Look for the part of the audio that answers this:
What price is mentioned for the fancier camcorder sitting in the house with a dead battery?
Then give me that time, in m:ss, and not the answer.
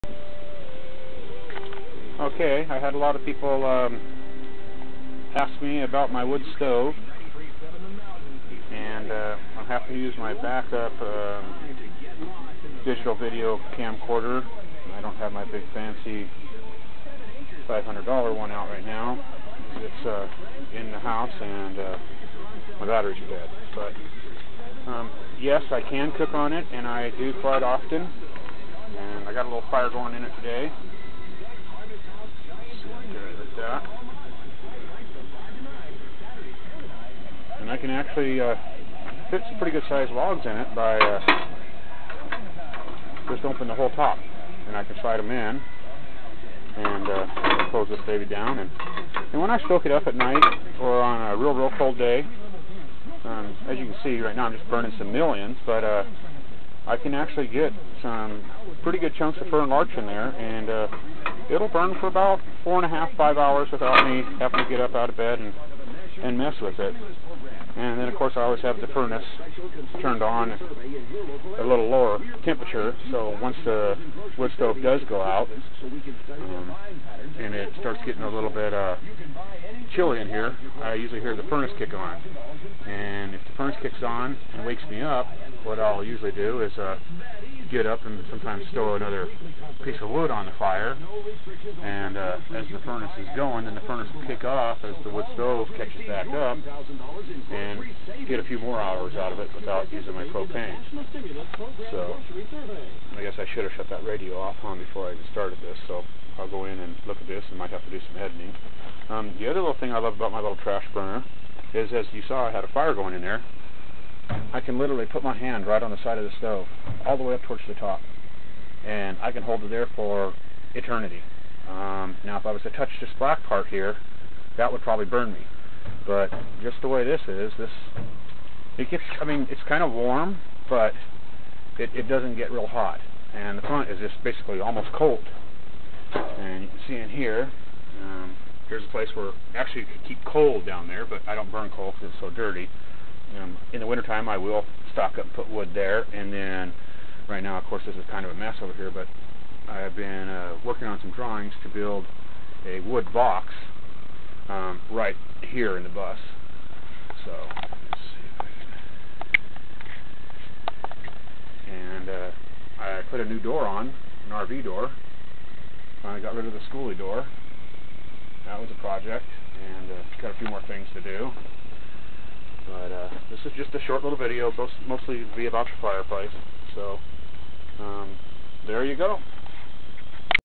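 0:17.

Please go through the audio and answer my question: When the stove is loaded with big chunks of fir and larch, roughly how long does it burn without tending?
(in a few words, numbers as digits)
4.5 to 5 hours.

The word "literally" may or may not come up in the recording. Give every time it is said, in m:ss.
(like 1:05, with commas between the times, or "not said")
1:54.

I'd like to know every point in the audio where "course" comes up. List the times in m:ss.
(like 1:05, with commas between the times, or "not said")
1:08, 2:27.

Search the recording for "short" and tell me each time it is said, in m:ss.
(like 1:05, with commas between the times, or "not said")
2:53.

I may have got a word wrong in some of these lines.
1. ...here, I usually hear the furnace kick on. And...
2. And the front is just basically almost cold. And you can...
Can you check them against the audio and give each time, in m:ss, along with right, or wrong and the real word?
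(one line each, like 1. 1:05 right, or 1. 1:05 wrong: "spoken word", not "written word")
1. 1:20 right
2. 2:13 right.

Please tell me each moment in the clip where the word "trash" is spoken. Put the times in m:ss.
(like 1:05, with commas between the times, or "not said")
1:50.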